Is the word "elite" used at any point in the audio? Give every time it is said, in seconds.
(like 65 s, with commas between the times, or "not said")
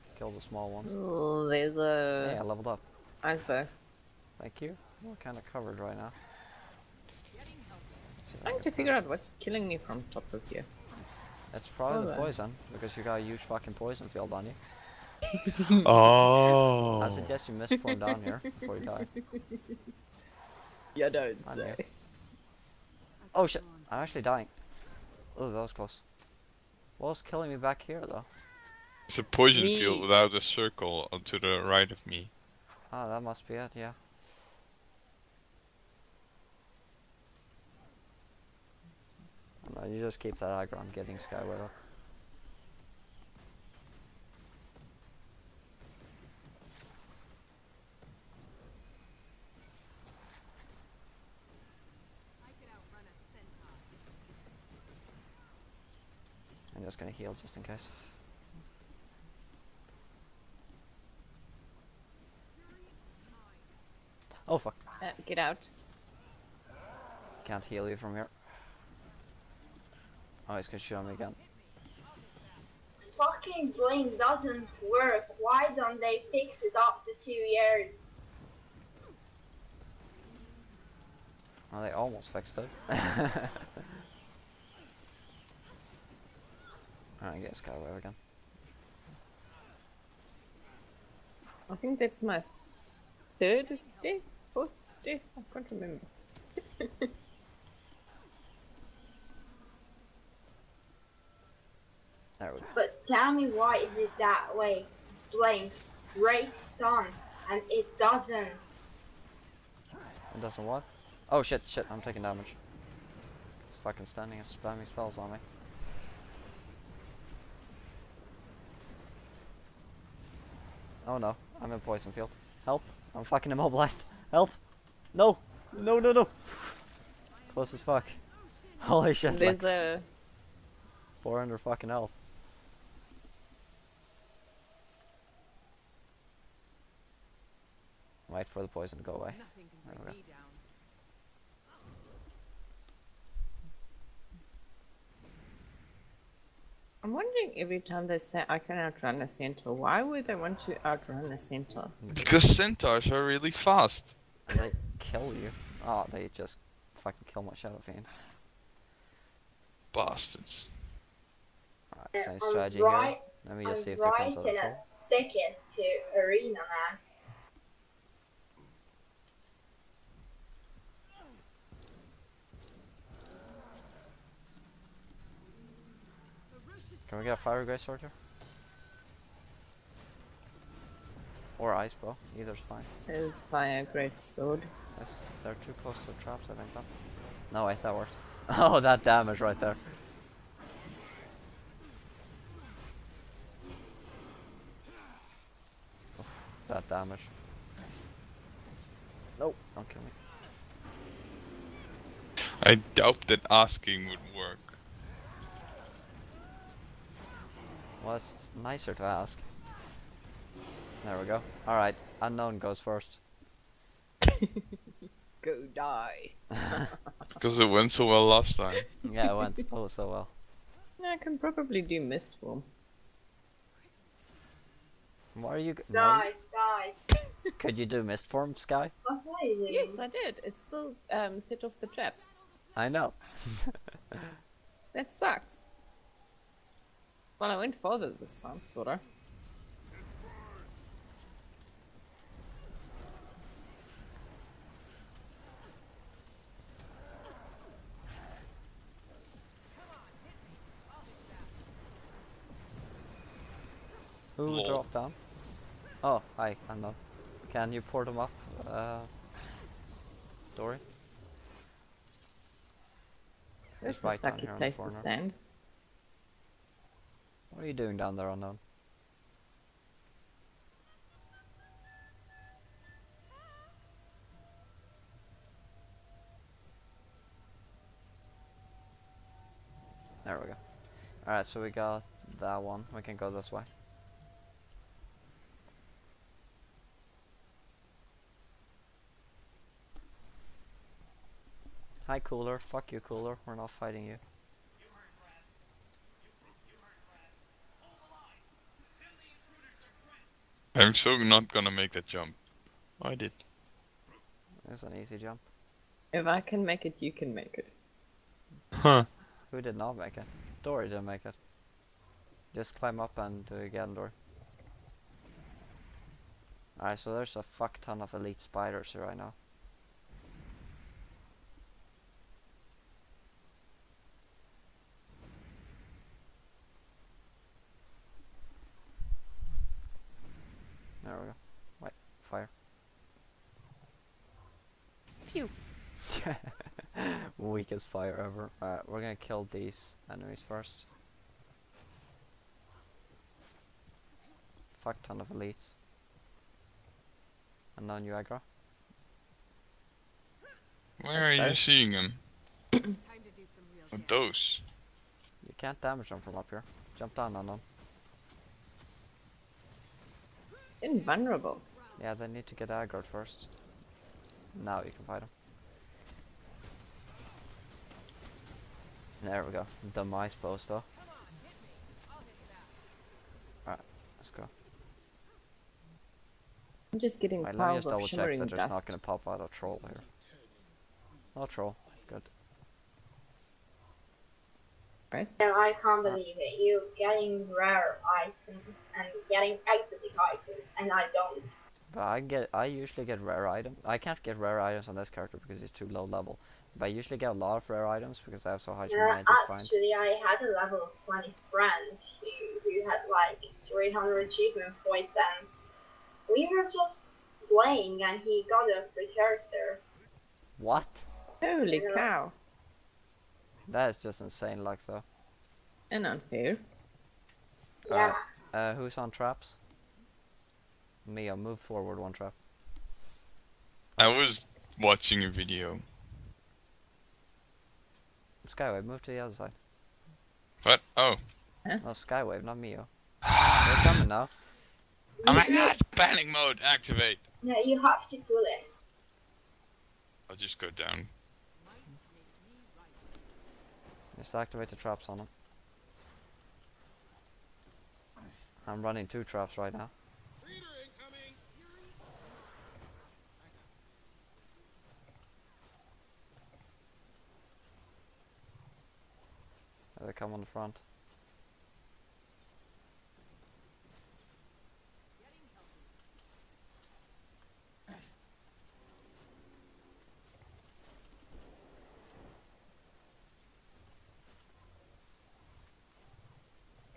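318 s, 345 s.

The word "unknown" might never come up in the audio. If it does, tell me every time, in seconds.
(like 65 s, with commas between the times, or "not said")
212 s, 268 s.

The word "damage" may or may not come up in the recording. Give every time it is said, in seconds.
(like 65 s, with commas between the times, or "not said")
112 s, 189 s, 196 s, 355 s.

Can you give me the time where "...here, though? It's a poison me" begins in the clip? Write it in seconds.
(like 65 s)
27 s.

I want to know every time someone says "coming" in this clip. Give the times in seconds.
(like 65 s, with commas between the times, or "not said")
433 s.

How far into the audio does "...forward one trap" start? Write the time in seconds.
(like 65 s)
421 s.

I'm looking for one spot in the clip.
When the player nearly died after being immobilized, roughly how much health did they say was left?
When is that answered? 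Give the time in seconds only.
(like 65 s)
131 s.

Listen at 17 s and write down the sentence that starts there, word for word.
I suggest you miss one down here before you die.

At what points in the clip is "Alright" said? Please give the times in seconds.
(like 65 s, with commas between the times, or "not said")
82 s, 161 s, 211 s, 281 s, 316 s, 338 s, 373 s.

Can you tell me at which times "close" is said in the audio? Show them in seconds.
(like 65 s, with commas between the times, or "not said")
25 s, 127 s, 185 s.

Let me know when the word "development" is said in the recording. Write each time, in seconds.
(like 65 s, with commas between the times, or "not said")
not said.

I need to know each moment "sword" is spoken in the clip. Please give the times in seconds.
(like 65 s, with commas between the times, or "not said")
184 s.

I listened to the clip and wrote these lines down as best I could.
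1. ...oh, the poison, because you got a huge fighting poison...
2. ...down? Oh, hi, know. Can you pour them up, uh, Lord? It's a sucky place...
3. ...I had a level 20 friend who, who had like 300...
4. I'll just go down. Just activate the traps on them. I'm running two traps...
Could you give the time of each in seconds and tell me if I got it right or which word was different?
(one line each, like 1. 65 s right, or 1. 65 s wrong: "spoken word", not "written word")
1. 12 s wrong: "fucking", not "fighting"
2. 254 s wrong: "Dory", not "Lord"
3. 399 s right
4. 440 s right.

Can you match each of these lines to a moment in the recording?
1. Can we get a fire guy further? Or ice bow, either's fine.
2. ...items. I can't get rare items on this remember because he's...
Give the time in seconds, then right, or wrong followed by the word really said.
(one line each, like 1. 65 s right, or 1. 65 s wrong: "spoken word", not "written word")
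1. 177 s wrong: "sorter", not "further"
2. 393 s wrong: "character", not "remember".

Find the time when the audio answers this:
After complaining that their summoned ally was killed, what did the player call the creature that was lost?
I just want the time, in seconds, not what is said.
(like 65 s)
157 s.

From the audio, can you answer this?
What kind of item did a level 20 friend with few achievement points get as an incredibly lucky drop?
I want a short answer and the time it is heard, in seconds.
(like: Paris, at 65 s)
precursor, at 408 s.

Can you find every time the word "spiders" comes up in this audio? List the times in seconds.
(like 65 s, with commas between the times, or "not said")
318 s.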